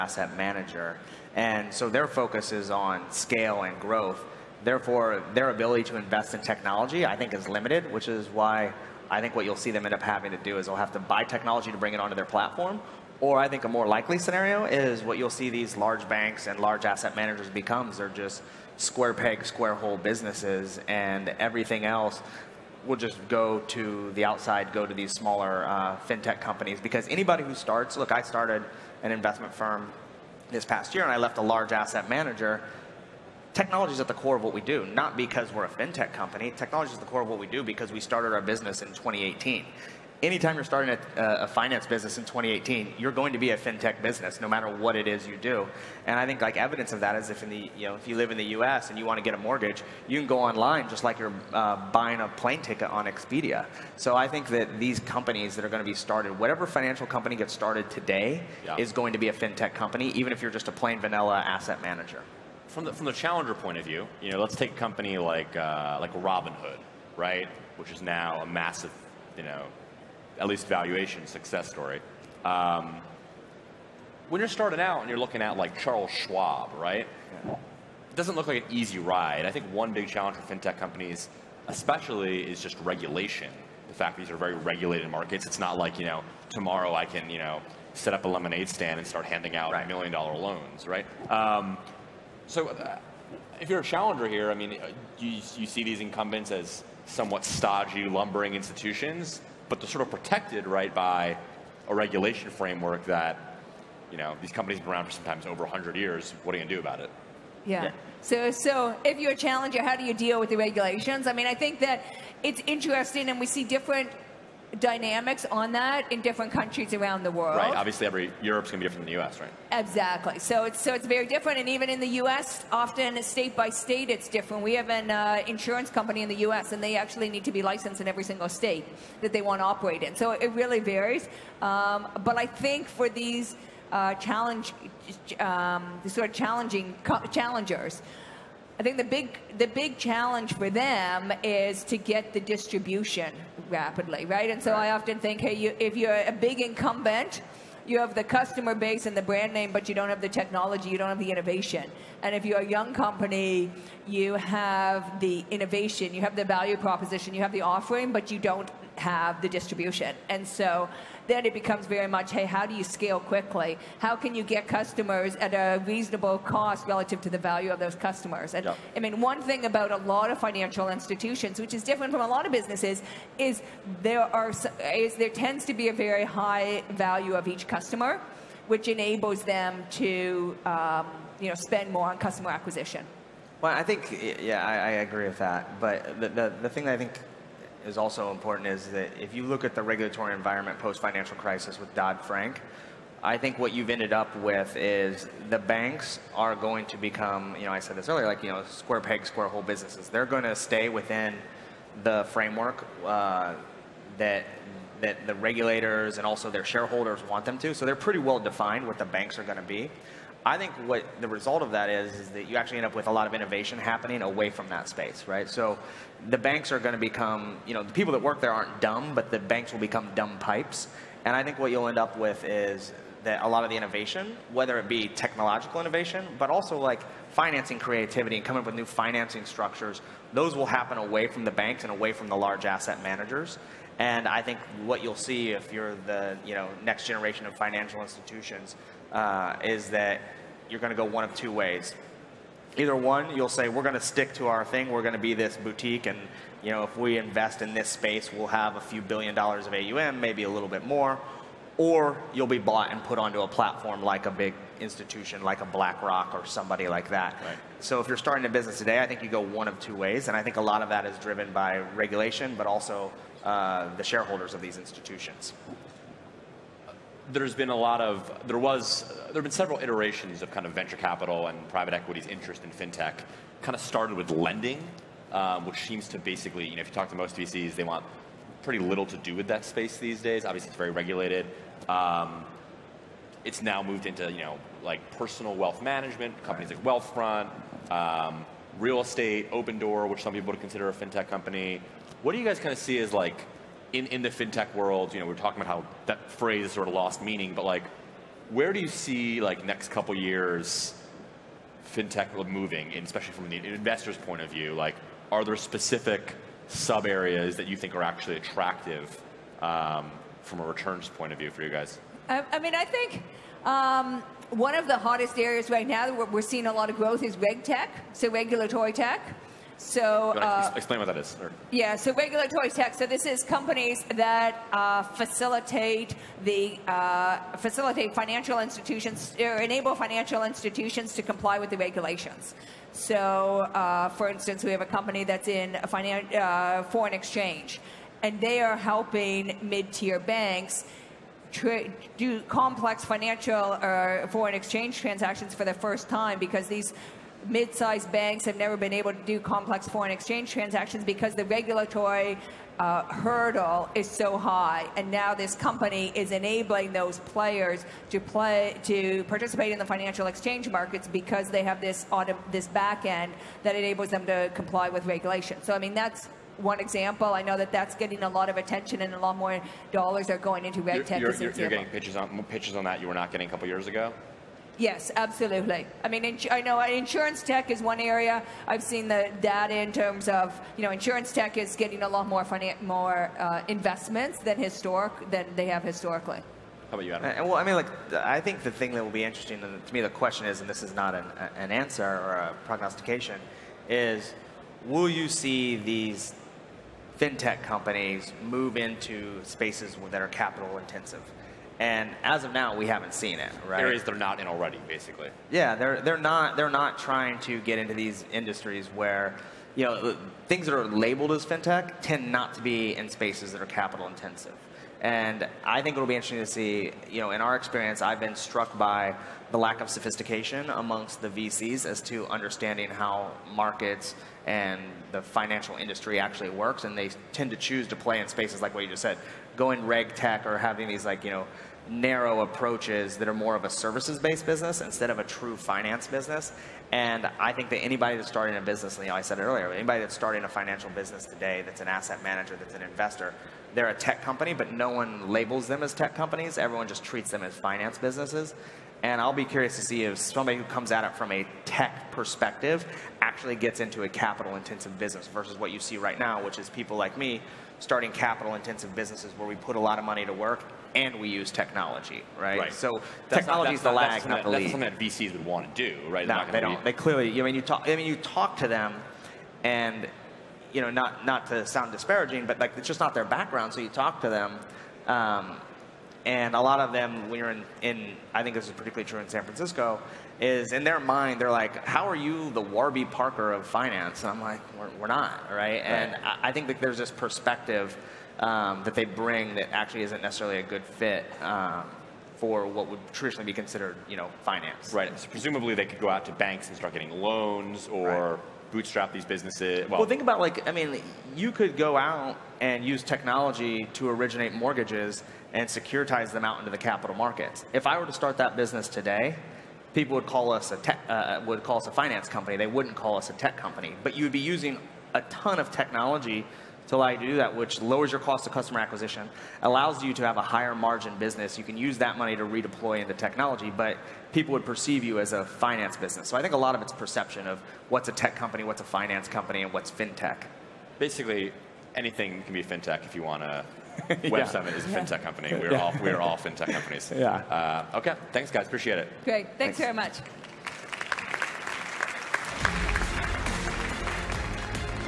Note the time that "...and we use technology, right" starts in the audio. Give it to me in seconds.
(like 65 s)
460 s.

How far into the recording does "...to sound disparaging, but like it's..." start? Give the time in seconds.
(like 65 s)
471 s.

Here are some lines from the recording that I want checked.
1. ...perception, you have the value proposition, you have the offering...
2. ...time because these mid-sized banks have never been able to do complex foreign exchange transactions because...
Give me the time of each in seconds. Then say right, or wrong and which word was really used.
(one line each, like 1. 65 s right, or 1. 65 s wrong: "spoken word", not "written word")
1. 155 s wrong: "innovation", not "perception"
2. 346 s right.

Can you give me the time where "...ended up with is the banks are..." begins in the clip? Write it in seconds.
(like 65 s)
193 s.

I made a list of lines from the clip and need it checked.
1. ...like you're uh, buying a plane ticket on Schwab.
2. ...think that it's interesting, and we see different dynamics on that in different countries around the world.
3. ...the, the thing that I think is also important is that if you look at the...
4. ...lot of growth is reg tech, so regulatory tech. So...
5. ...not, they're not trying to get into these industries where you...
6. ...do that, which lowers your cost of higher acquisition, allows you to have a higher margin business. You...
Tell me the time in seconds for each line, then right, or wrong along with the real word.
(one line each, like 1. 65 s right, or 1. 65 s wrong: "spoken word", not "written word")
1. 51 s wrong: "Expedia", not "Schwab"
2. 111 s right
3. 186 s right
4. 316 s right
5. 406 s right
6. 517 s wrong: "customer", not "higher".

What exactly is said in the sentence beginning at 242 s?
Either one, you'll say we're going to stick to our thing.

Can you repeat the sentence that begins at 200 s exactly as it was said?
They're going to stay within the framework uh, that that the regulators and also their shareholders want them to.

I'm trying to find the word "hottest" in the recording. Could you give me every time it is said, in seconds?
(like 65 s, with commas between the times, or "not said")
314 s.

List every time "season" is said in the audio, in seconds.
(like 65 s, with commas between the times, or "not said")
not said.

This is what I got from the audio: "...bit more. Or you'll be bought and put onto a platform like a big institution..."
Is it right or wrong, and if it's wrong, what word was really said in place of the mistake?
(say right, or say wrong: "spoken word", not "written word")
right.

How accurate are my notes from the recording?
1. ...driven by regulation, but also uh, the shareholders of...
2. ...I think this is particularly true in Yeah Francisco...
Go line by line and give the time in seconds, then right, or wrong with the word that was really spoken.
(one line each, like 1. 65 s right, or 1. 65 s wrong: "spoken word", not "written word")
1. 261 s right
2. 478 s wrong: "San", not "Yeah".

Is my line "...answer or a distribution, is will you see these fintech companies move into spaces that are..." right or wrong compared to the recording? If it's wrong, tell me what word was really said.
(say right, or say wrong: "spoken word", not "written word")
wrong: "prognostication", not "distribution".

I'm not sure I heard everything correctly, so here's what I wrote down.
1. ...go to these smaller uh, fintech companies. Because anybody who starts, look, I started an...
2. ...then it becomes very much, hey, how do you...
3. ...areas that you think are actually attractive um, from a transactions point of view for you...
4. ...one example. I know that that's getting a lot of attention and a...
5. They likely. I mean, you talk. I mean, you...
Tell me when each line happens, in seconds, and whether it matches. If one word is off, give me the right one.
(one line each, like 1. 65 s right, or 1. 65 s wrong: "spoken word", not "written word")
1. 24 s right
2. 161 s right
3. 307 s wrong: "returns", not "transactions"
4. 366 s right
5. 466 s wrong: "clearly", not "likely".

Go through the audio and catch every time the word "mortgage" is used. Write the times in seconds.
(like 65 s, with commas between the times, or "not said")
49 s, 504 s.